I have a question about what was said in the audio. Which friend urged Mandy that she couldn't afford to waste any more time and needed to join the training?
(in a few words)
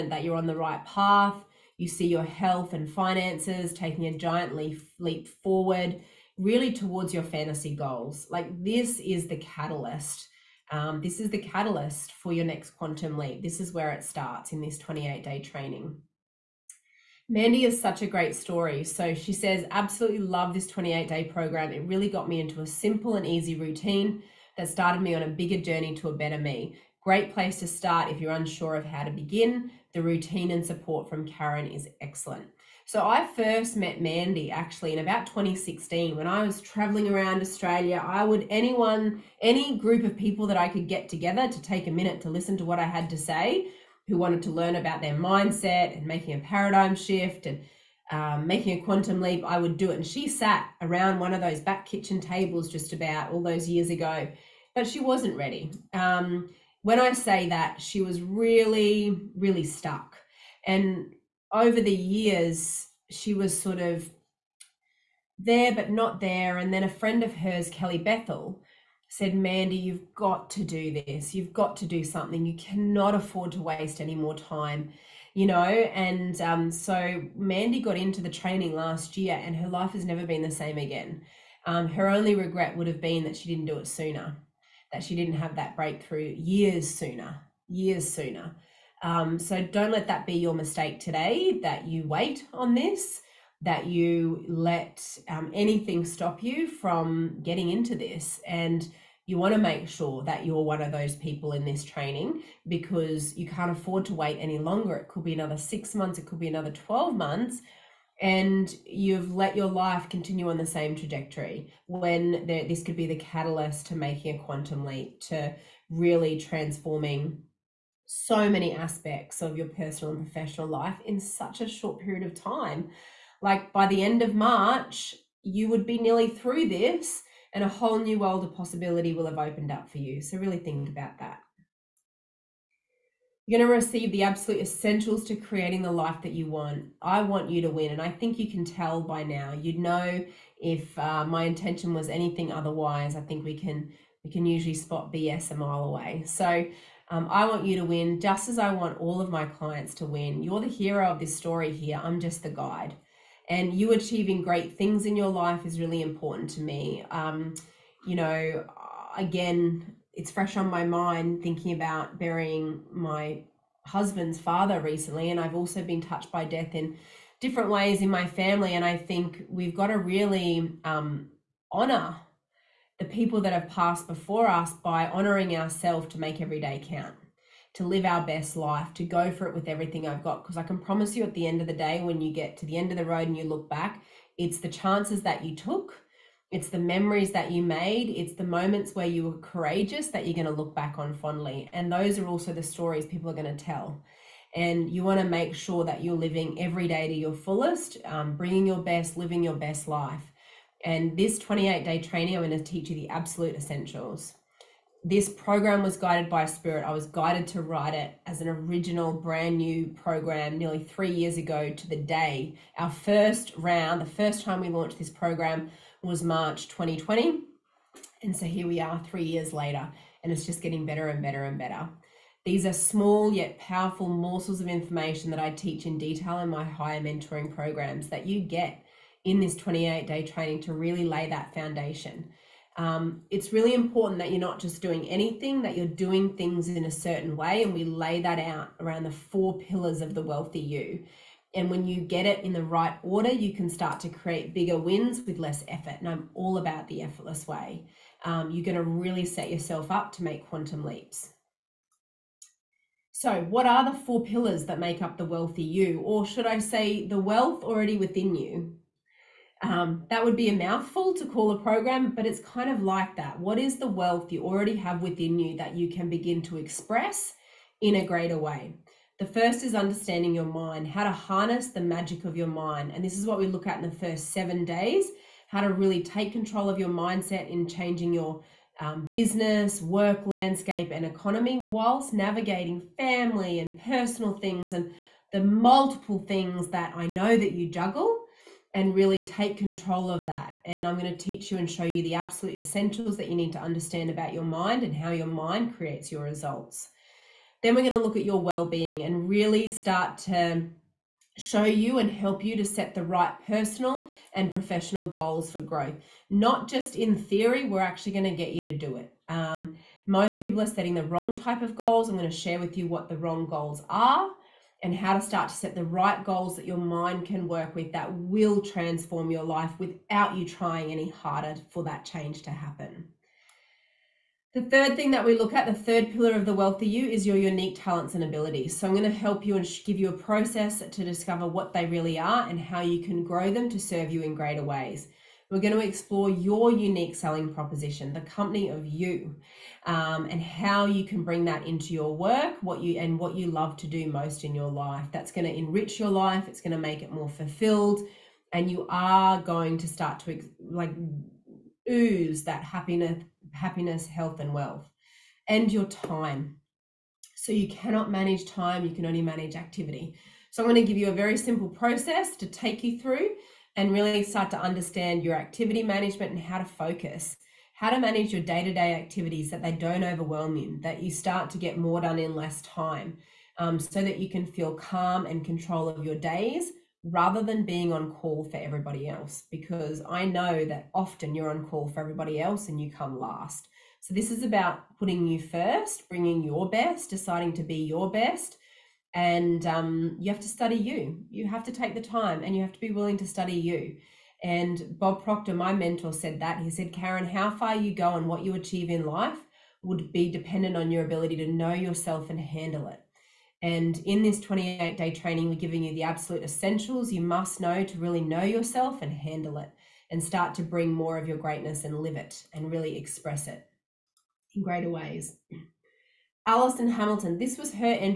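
Kelly Bethel.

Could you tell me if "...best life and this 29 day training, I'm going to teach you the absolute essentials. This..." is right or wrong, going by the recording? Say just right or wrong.
wrong.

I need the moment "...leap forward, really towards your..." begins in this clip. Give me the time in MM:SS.
00:04.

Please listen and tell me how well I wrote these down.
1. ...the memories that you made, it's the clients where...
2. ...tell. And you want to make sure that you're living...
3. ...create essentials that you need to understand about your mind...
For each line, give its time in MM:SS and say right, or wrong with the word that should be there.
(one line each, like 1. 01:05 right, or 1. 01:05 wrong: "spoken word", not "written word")
1. 03:06 wrong: "moments", not "clients"
2. 03:13 right
3. 04:52 wrong: "absolute", not "create".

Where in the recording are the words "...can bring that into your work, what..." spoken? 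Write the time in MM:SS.
05:41.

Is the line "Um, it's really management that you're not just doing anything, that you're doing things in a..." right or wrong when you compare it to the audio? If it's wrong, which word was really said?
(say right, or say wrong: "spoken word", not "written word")
wrong: "important", not "management".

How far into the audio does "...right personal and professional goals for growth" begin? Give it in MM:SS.
05:03.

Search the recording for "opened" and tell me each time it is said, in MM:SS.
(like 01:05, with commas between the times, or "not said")
02:09.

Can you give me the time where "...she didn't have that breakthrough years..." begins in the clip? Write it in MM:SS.
01:25.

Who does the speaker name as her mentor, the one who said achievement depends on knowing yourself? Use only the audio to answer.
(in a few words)
Bob Proctor.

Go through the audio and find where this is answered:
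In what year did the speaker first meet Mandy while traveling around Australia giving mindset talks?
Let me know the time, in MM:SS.
00:35.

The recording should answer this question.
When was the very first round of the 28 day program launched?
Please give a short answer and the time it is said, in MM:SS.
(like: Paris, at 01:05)
March 2020, at 03:36.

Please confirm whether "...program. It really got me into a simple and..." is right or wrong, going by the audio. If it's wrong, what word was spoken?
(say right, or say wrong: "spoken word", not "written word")
right.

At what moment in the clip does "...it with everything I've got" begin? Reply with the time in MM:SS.
02:59.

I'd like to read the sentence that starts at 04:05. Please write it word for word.
And I'm all about the effortless way.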